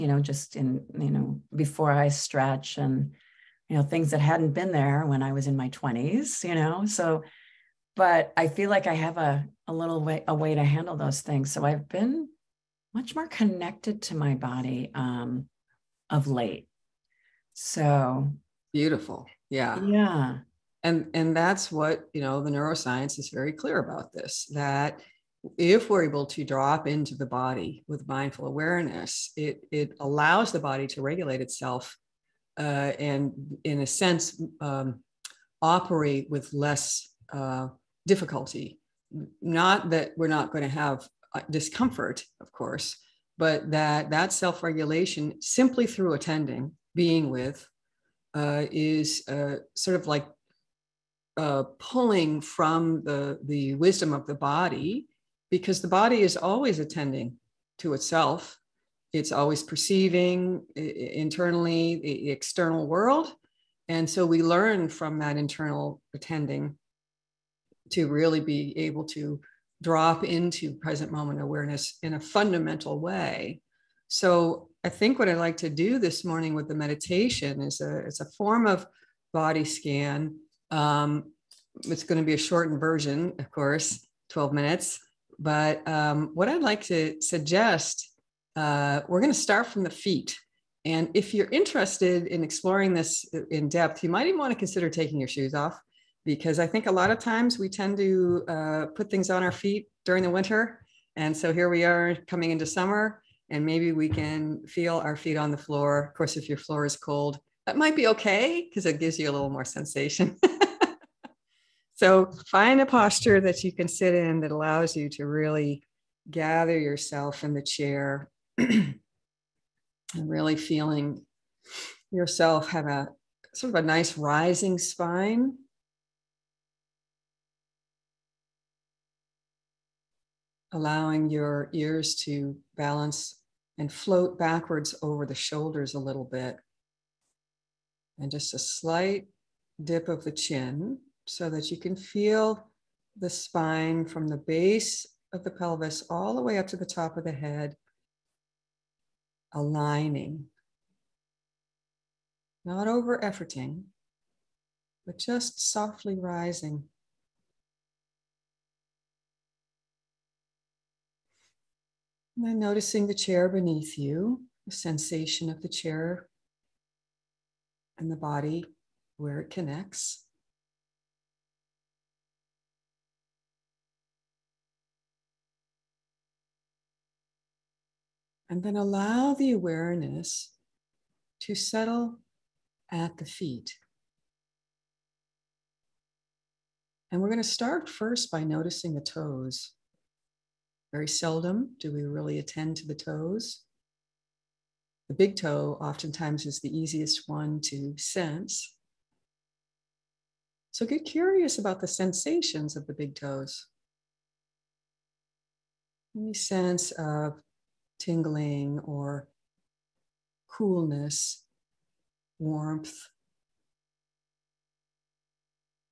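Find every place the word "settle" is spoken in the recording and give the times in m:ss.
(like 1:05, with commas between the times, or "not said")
3:01.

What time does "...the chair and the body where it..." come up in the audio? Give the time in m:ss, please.
2:45.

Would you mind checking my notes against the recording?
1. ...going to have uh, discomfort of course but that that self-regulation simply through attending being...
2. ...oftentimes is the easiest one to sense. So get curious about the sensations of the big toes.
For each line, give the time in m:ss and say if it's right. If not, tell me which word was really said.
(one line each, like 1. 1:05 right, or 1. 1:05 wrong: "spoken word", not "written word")
1. 0:40 right
2. 3:15 right.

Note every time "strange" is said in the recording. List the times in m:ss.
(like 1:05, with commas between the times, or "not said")
not said.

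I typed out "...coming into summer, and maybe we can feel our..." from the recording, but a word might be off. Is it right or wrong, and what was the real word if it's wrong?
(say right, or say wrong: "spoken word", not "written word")
right.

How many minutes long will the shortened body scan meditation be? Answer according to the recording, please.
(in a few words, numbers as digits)
12.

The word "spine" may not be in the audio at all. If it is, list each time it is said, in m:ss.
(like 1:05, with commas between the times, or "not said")
2:04, 2:23.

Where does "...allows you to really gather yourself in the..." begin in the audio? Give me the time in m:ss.
1:54.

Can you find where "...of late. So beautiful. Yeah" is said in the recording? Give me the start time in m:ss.
0:16.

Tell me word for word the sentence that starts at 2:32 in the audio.
Not over efforting, but just softly rising.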